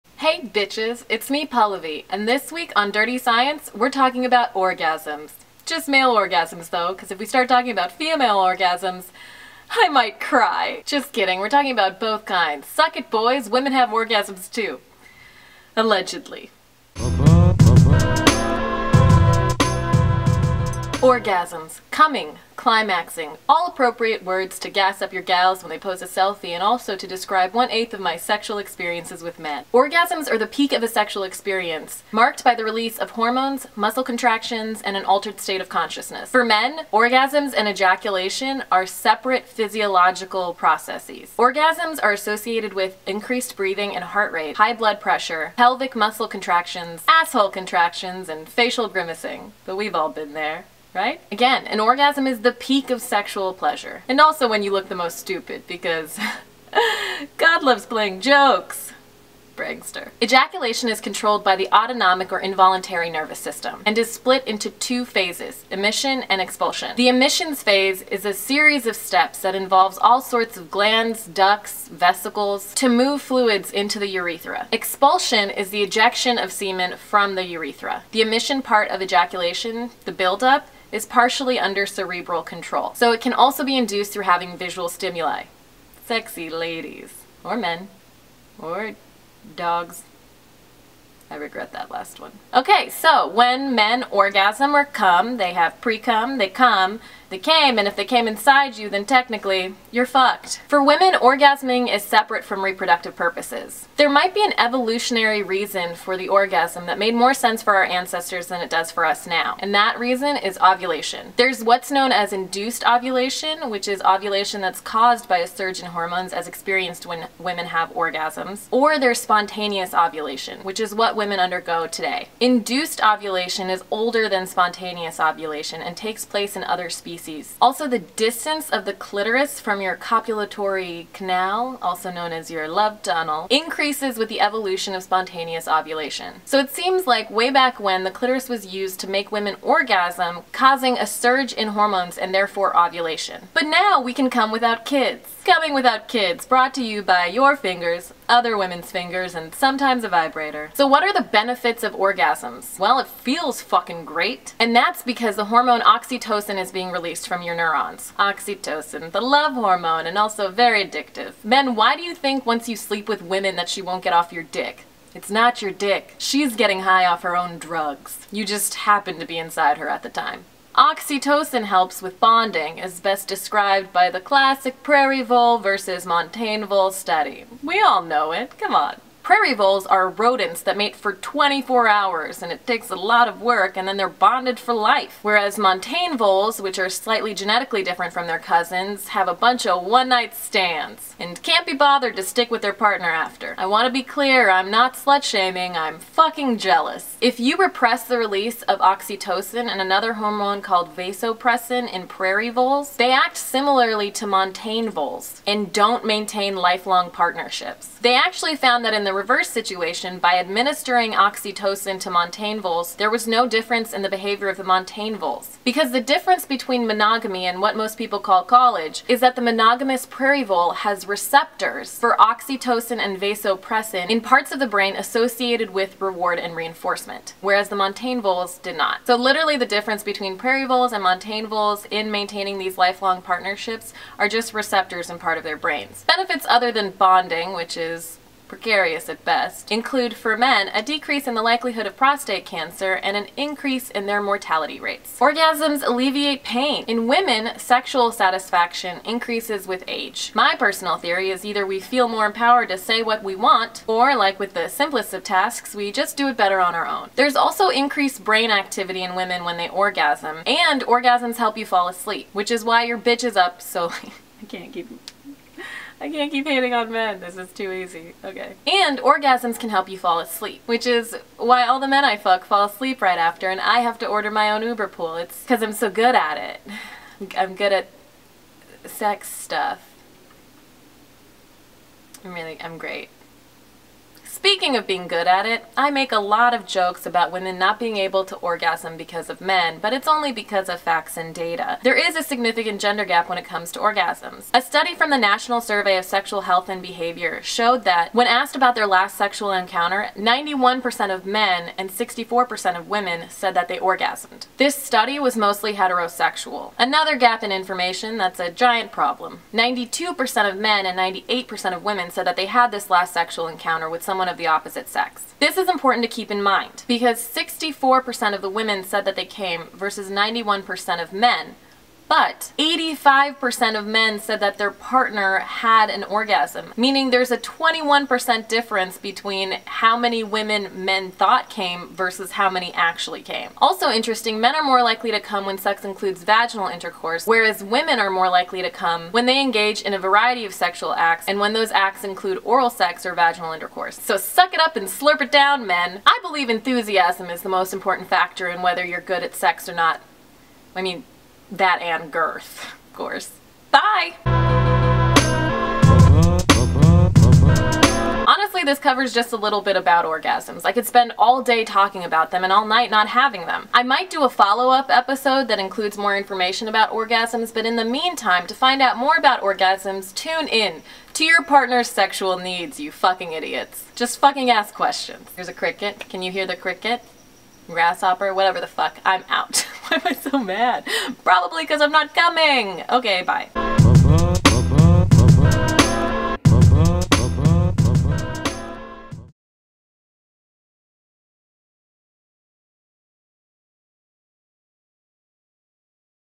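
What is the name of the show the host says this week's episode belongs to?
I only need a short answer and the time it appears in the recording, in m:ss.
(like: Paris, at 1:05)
Dirty Science, at 0:02.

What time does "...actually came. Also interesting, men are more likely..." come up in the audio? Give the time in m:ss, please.
5:32.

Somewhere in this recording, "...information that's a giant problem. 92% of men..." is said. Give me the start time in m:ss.
5:07.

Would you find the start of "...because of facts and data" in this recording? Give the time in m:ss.
4:50.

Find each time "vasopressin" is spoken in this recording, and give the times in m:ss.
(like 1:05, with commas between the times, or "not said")
3:20, 3:43.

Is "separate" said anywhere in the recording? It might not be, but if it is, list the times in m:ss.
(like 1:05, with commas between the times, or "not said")
0:38, 1:42.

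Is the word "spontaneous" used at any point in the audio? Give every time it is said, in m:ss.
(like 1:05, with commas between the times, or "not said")
1:59, 2:04, 2:15.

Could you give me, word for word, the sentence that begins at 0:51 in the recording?
Again, an orgasm is the peak of sexual pleasure.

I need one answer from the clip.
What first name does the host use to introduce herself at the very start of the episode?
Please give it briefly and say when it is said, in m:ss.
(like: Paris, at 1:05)
Pallavi, at 0:01.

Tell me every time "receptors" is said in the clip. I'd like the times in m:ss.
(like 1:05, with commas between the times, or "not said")
3:41, 3:54.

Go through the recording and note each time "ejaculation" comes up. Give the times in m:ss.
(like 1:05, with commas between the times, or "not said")
0:37, 1:00, 1:19.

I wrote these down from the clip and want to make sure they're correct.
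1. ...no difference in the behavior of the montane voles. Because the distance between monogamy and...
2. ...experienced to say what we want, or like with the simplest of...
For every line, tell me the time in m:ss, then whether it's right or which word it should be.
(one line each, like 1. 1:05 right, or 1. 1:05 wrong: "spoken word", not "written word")
1. 3:33 wrong: "difference", not "distance"
2. 4:12 wrong: "empowered", not "experienced".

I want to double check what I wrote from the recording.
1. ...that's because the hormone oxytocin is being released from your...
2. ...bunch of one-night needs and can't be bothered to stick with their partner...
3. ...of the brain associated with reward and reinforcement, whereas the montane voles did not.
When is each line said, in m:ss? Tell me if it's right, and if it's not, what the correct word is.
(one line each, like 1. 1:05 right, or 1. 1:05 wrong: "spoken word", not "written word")
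1. 2:34 right
2. 3:09 wrong: "stands", not "needs"
3. 3:44 right.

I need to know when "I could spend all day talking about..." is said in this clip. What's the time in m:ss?
6:00.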